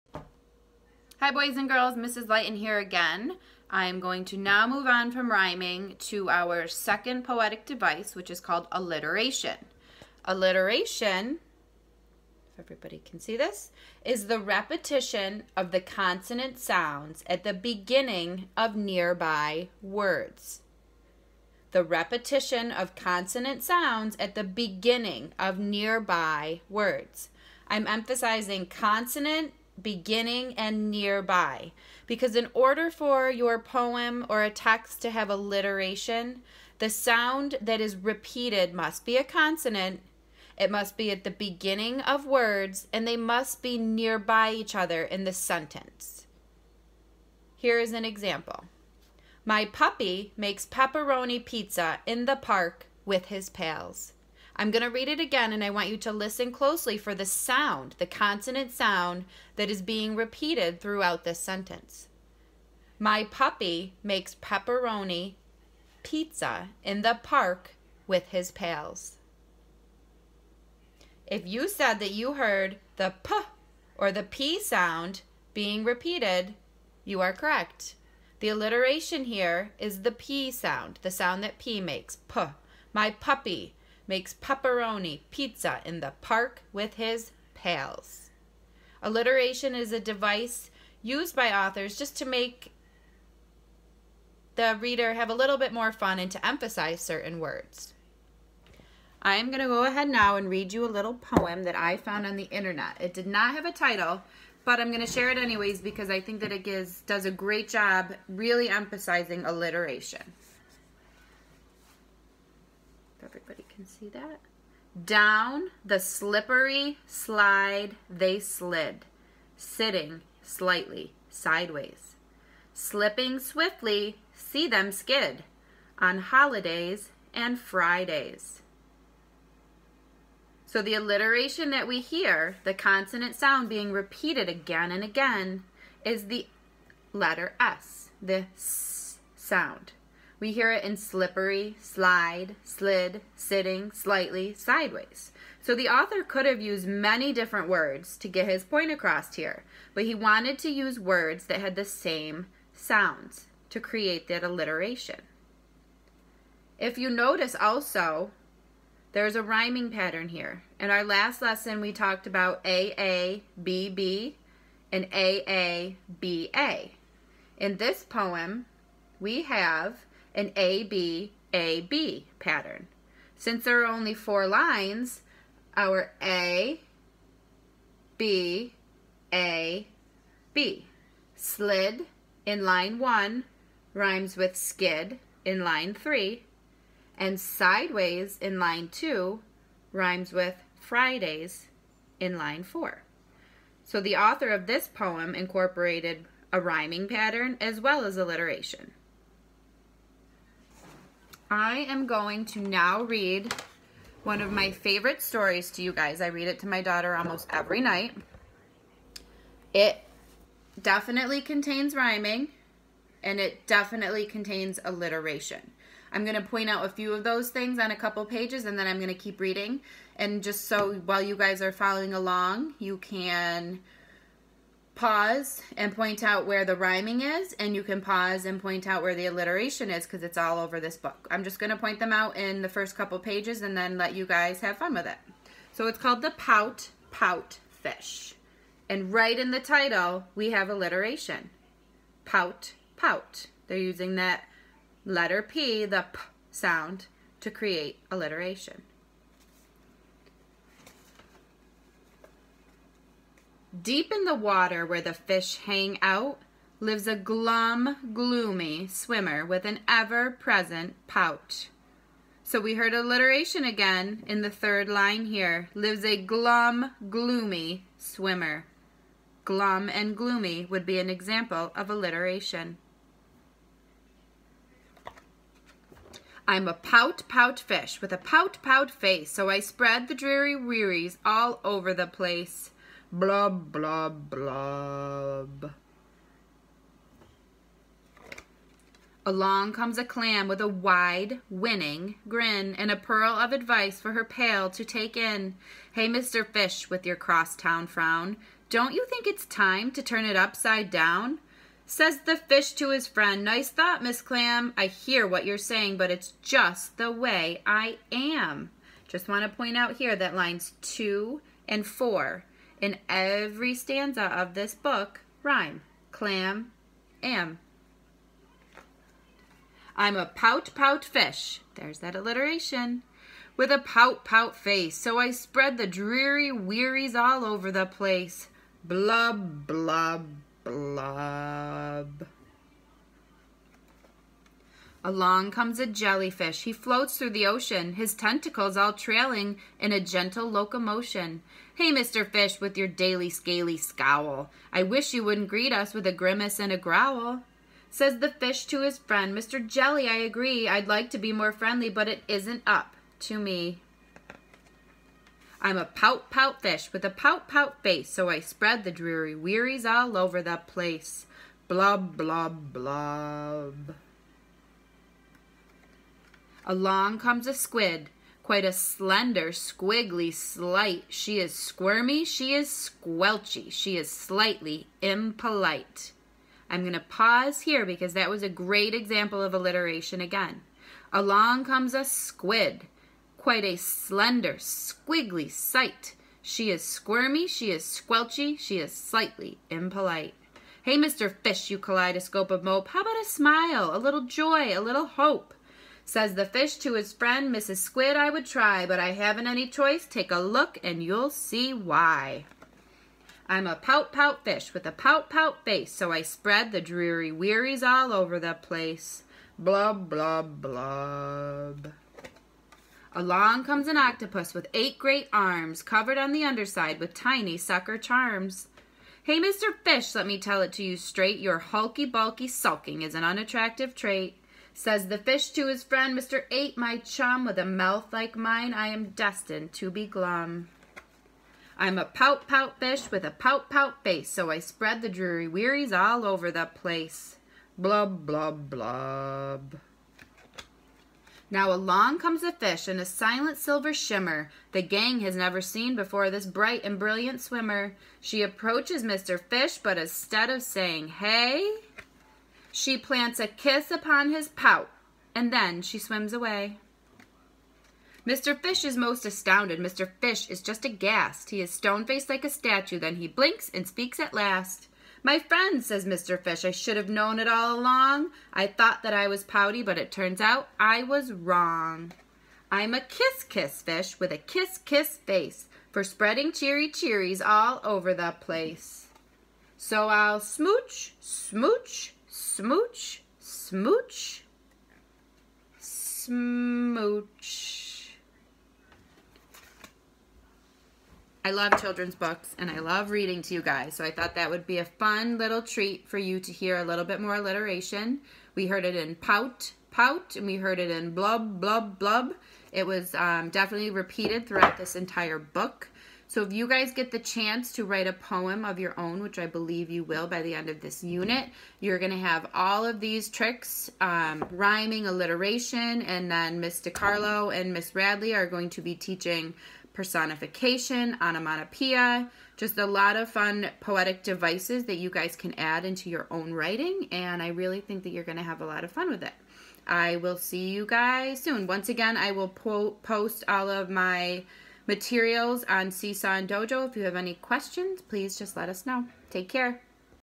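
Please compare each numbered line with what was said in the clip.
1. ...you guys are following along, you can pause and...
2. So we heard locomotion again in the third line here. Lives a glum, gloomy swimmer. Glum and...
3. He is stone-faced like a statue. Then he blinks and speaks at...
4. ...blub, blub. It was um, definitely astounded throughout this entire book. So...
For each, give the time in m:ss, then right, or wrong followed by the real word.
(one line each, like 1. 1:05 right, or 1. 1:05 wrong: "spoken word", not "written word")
1. 3:41 right
2. 4:22 wrong: "alliteration", not "locomotion"
3. 7:41 right
4. 8:21 wrong: "repeated", not "astounded".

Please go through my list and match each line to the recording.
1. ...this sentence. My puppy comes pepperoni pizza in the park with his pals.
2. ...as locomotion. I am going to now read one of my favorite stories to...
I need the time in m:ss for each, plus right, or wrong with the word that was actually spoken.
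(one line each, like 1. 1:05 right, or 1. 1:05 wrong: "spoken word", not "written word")
1. 1:01 wrong: "makes", not "comes"
2. 3:18 wrong: "alliteration", not "locomotion".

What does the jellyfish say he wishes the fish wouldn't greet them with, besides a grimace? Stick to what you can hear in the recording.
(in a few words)
a growl.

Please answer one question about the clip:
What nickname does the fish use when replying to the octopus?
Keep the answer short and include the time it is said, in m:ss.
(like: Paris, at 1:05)
Mr. Eight, at 7:06.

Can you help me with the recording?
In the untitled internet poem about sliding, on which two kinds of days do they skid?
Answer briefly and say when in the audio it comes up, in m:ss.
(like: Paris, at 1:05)
holidays and Fridays, at 2:06.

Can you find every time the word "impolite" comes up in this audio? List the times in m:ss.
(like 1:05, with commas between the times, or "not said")
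6:15, 6:29.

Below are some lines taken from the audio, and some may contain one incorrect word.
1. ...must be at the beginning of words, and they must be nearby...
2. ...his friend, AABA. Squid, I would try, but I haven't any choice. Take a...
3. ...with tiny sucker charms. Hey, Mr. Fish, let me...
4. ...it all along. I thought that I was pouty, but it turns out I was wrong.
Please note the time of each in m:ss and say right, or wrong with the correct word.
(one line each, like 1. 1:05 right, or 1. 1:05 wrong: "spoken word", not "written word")
1. 0:40 right
2. 6:36 wrong: "Mrs", not "AABA"
3. 6:56 right
4. 7:47 right.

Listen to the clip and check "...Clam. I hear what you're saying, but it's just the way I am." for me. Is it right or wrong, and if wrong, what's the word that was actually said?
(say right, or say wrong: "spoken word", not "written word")
right.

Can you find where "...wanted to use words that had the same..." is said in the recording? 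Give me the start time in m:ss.
2:30.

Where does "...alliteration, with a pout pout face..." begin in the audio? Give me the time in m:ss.
5:22.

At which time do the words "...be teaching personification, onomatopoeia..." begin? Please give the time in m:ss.
8:38.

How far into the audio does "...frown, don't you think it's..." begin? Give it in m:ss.
4:57.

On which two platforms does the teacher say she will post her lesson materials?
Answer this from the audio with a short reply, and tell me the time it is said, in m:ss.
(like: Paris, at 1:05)
Seesaw and Dojo, at 8:55.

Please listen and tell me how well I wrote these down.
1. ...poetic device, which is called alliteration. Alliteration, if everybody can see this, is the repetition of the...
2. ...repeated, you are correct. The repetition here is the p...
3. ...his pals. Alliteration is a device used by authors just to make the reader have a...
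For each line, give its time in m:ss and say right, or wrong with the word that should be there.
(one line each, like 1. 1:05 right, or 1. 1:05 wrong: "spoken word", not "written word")
1. 0:07 right
2. 1:15 wrong: "alliteration", not "repetition"
3. 1:26 right.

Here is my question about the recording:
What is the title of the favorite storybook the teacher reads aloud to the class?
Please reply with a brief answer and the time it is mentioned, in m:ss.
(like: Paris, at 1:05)
The Pout Pout Fish, at 3:56.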